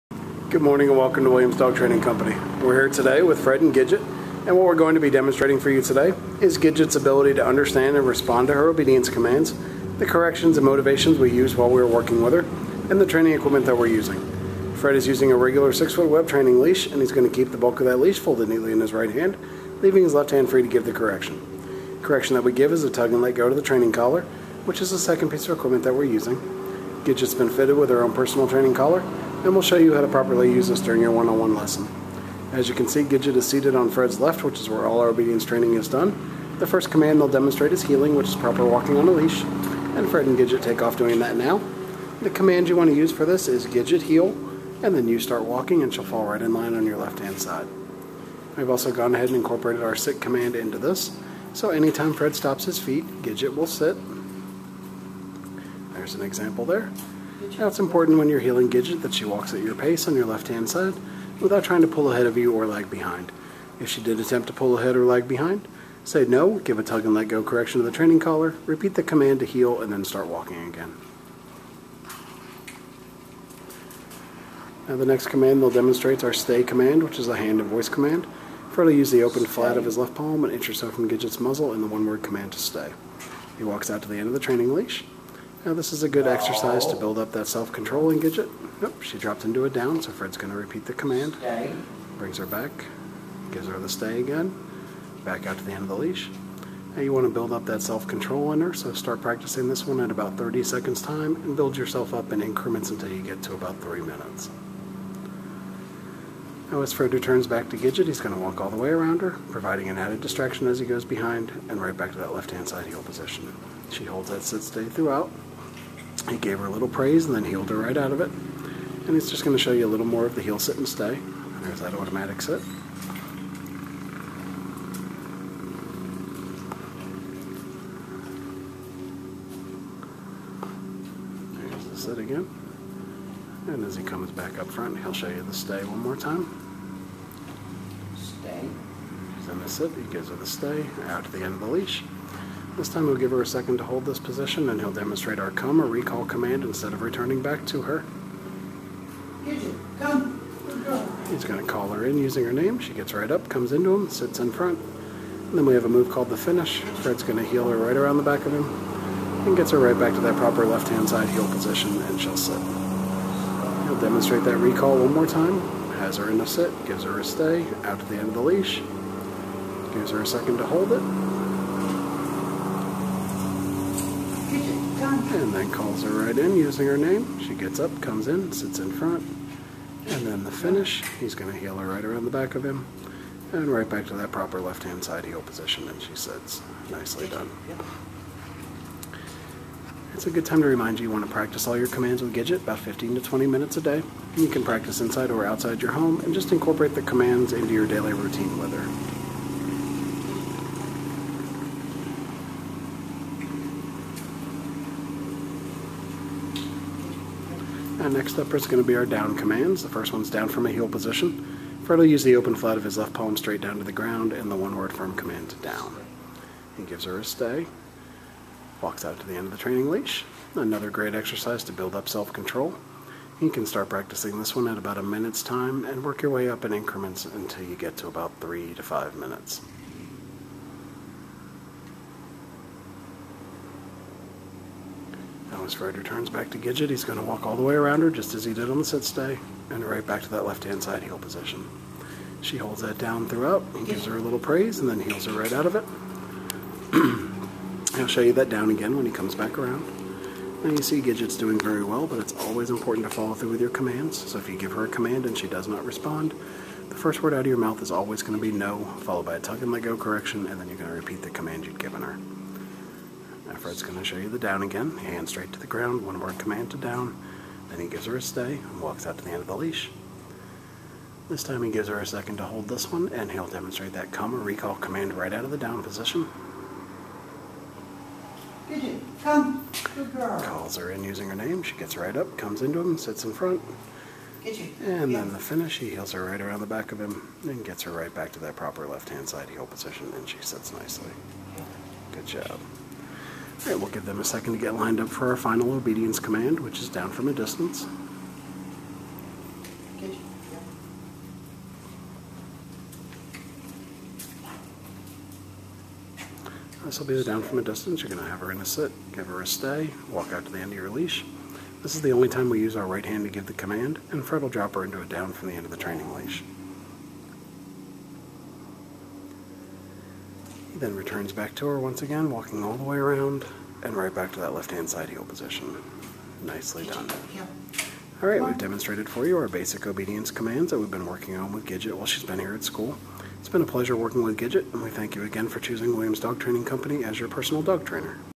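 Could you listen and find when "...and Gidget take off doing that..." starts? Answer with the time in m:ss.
0:40.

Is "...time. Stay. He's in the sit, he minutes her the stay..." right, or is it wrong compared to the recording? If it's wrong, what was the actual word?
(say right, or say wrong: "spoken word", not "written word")
wrong: "gives", not "minutes".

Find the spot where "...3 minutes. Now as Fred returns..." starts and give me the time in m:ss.
1:43.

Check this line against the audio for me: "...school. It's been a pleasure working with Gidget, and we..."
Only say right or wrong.
right.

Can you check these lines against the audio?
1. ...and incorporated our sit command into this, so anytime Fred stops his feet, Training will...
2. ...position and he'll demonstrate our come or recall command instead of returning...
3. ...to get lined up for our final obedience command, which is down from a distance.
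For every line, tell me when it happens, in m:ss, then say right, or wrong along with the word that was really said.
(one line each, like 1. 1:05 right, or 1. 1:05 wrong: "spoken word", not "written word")
1. 0:49 wrong: "Gidget", not "Training"
2. 2:24 right
3. 4:54 right.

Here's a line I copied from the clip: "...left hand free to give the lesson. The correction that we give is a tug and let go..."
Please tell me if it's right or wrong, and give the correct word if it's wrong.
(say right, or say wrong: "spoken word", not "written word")
wrong: "correction", not "lesson".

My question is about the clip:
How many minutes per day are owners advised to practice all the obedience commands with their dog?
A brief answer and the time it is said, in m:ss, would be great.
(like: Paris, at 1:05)
15 to 20 minutes, at 3:12.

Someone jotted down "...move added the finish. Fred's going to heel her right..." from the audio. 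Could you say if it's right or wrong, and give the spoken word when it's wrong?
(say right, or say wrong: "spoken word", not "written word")
wrong: "called", not "added".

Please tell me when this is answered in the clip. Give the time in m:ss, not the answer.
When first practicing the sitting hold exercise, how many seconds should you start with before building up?
1:40.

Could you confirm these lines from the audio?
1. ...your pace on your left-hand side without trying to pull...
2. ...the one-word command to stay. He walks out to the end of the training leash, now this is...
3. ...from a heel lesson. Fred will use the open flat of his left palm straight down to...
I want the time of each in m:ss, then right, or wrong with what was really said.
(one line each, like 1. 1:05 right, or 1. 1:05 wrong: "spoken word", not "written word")
1. 0:59 right
2. 1:21 right
3. 3:30 wrong: "position", not "lesson".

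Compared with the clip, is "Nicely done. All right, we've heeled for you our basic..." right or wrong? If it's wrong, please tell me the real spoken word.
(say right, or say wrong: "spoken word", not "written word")
wrong: "demonstrated", not "heeled".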